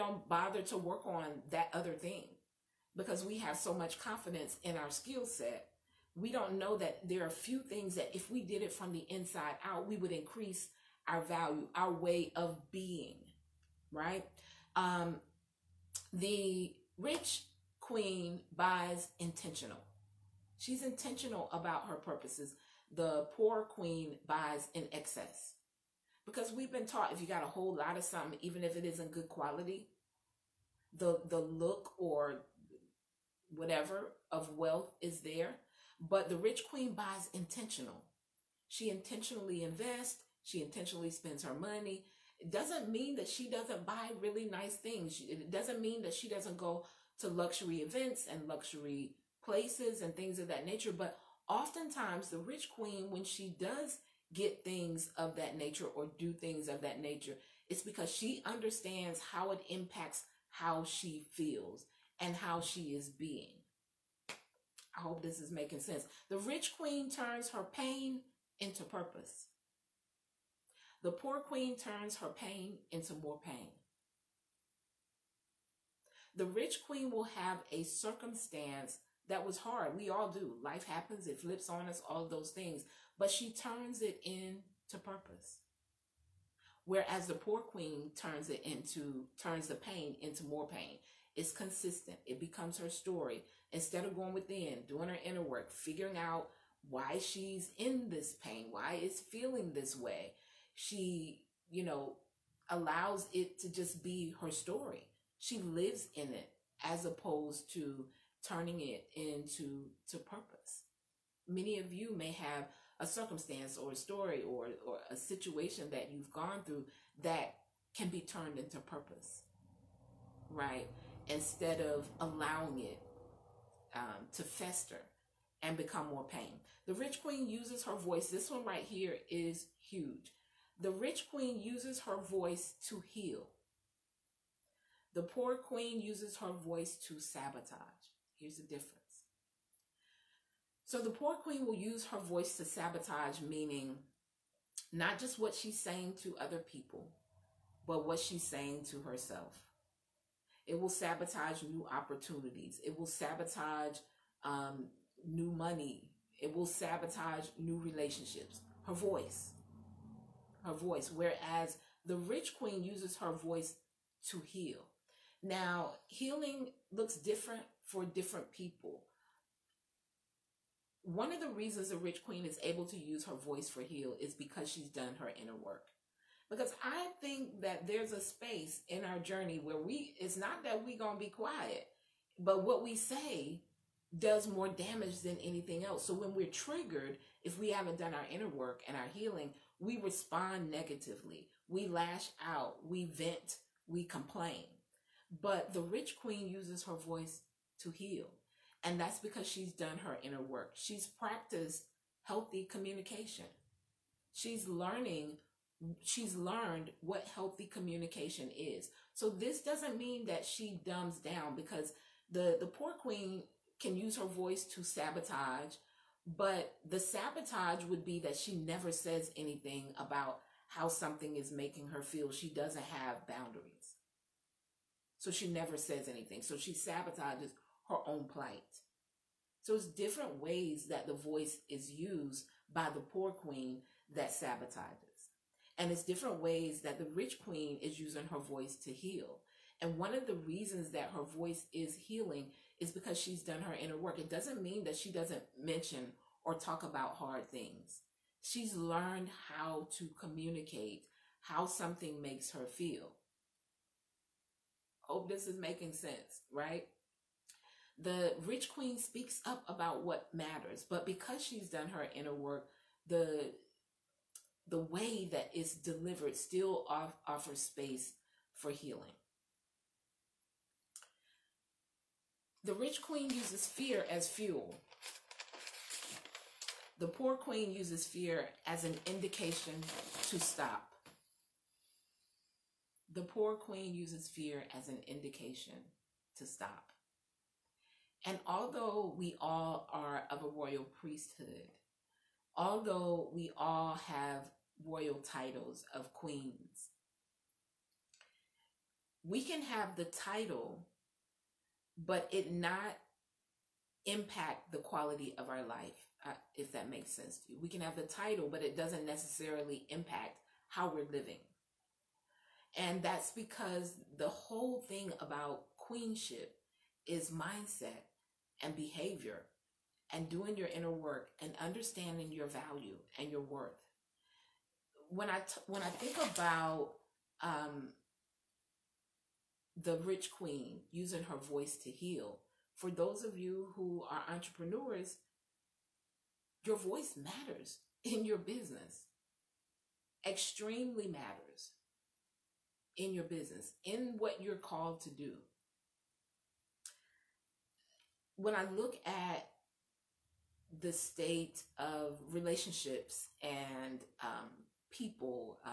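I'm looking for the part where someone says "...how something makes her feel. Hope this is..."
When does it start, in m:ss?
4:11.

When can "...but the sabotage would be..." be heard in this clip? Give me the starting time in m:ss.
3:36.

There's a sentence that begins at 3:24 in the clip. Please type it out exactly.
She's learning she's learned what healthy communication is.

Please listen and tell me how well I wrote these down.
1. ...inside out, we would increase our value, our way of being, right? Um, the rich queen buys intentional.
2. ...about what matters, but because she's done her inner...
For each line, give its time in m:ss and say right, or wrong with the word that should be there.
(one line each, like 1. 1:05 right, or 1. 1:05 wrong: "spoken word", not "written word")
1. 0:09 right
2. 4:19 right.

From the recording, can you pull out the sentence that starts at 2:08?
This one right here is huge.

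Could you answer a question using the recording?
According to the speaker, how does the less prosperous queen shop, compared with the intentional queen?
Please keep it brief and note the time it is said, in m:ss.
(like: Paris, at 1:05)
In excess, at 0:24.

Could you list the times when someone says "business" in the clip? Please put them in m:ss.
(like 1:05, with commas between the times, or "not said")
5:38, 5:43.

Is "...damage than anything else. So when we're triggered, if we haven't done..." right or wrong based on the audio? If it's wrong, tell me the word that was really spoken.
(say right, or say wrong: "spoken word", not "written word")
right.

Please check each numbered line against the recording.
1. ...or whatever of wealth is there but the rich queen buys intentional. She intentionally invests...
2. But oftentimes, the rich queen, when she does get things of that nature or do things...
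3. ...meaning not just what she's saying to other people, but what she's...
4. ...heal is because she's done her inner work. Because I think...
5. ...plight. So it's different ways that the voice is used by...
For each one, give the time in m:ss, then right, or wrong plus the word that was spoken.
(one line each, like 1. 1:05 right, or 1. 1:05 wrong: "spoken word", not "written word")
1. 0:31 right
2. 0:50 right
3. 2:23 right
4. 2:53 right
5. 3:48 right.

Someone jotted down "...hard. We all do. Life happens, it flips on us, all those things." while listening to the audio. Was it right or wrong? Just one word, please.
right.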